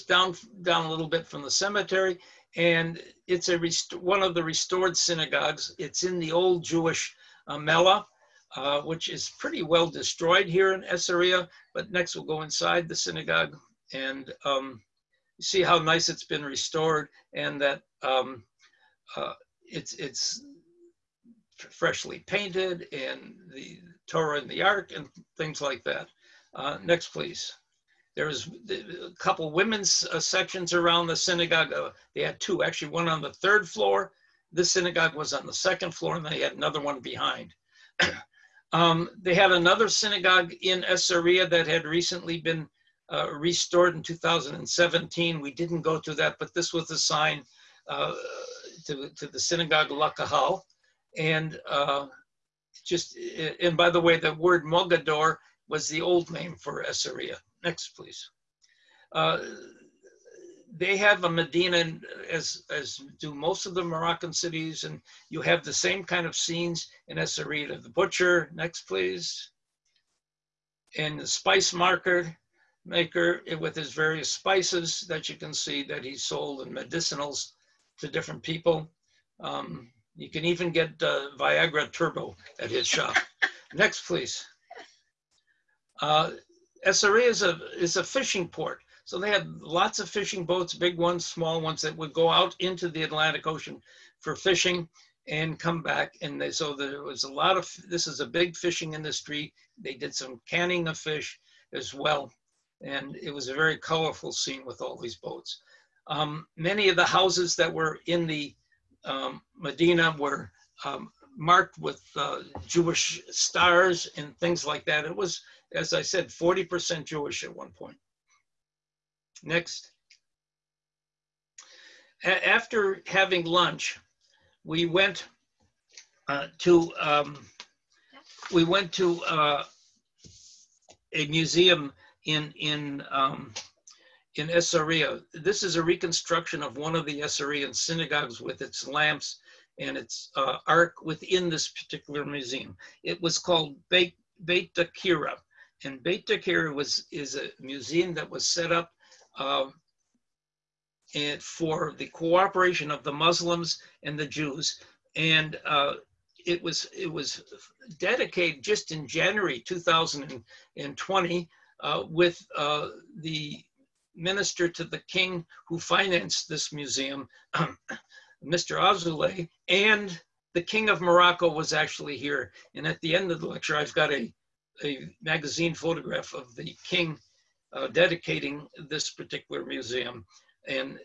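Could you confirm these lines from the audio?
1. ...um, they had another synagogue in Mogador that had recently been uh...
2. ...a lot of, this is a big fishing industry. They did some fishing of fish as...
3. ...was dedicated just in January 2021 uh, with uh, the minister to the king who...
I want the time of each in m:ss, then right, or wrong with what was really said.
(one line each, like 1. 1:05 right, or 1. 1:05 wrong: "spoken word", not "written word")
1. 0:38 wrong: "Esseria", not "Mogador"
2. 1:37 wrong: "canning", not "fishing"
3. 2:37 wrong: "2020", not "2021".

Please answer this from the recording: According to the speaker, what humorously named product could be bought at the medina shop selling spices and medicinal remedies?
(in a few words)
Viagra Turbo.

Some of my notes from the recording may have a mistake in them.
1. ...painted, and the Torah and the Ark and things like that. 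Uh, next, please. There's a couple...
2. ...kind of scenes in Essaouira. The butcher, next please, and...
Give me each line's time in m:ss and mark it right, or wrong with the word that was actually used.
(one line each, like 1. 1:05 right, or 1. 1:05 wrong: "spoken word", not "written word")
1. 0:22 right
2. 1:06 right.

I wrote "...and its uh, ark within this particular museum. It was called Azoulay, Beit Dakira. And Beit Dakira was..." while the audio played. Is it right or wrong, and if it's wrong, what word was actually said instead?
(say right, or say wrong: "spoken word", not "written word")
wrong: "Beit", not "Azoulay".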